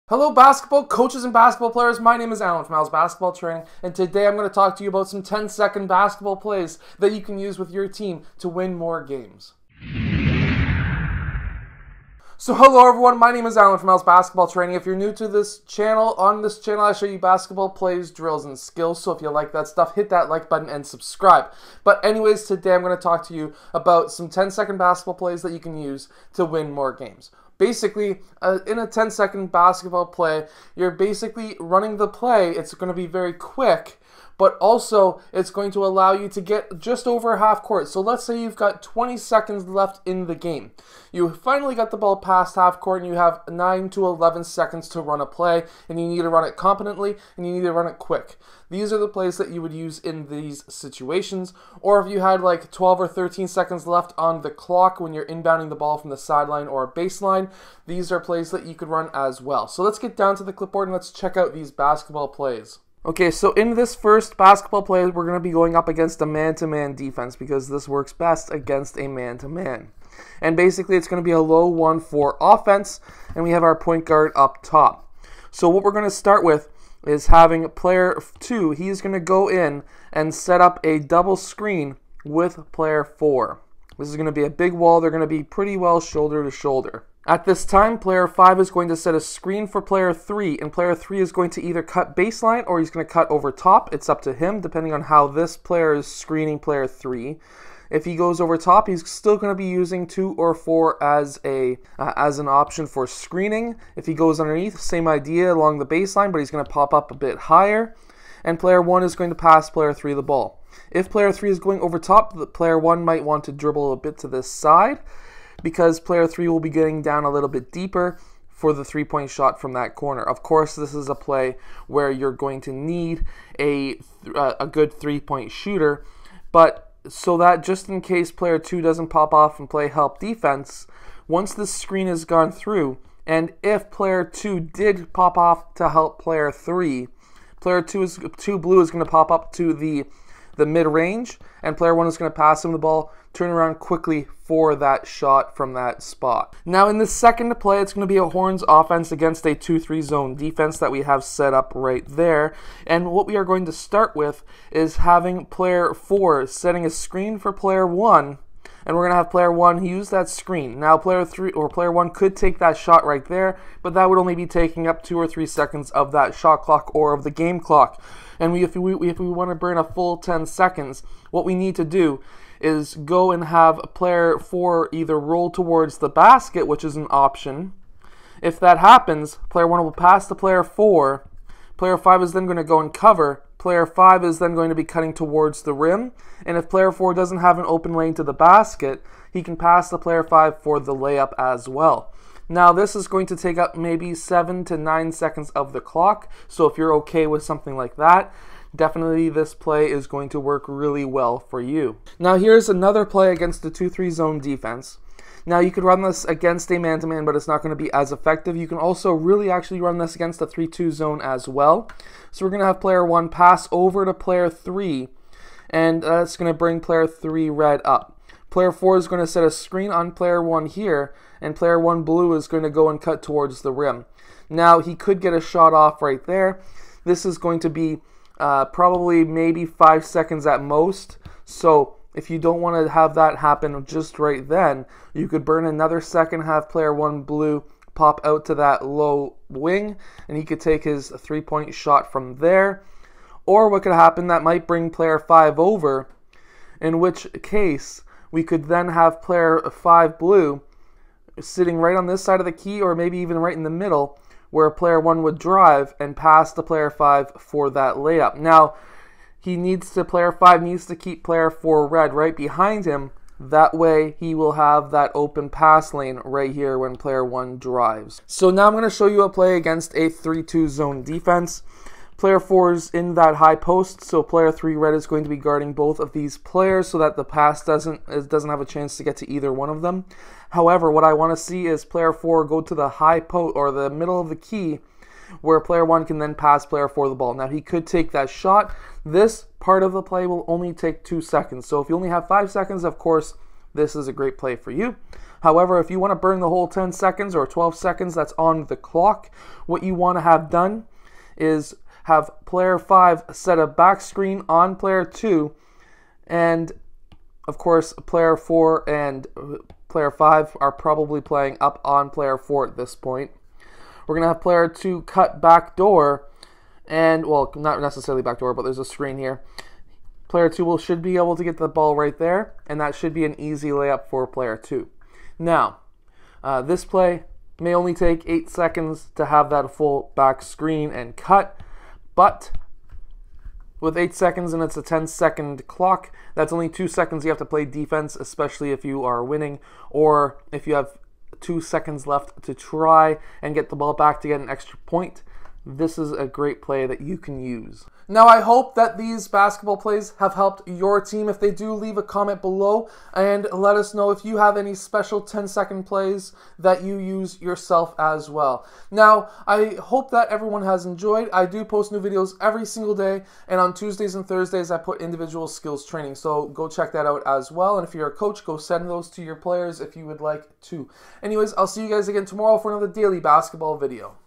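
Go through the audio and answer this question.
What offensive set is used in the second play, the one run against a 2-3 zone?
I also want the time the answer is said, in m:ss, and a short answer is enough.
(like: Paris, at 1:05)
Horns, at 2:28.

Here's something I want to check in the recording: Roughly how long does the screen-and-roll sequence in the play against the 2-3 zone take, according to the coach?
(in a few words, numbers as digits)
7 to 9 seconds.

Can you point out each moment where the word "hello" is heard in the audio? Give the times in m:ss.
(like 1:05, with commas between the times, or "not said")
0:00, 0:12.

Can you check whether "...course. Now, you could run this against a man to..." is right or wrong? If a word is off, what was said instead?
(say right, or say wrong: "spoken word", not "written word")
wrong: "defense", not "course".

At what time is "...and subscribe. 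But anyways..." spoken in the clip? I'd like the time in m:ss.
0:20.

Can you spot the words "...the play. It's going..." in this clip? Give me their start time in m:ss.
0:31.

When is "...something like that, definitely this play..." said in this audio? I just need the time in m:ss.
3:17.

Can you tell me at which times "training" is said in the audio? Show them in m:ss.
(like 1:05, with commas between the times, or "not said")
0:03, 0:14, 6:05.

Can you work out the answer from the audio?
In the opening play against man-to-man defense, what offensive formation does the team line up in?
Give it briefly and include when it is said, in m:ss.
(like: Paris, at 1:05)
low 1-4 offense, at 1:11.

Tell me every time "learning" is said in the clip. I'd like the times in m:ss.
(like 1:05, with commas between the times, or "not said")
not said.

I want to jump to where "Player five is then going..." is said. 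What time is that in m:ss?
3:01.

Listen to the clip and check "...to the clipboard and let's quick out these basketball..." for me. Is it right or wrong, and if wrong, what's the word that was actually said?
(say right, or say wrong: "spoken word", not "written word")
wrong: "check", not "quick".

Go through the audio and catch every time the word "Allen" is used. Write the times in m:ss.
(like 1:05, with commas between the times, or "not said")
0:02, 0:13.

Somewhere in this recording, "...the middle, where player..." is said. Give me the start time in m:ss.
4:13.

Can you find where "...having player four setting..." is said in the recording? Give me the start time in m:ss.
2:34.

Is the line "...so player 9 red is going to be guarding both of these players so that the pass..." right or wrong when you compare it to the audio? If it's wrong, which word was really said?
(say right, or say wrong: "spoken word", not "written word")
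wrong: "3", not "9".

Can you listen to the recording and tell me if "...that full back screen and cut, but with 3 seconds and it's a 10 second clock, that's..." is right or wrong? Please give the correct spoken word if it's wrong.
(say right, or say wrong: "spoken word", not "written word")
wrong: "8", not "3".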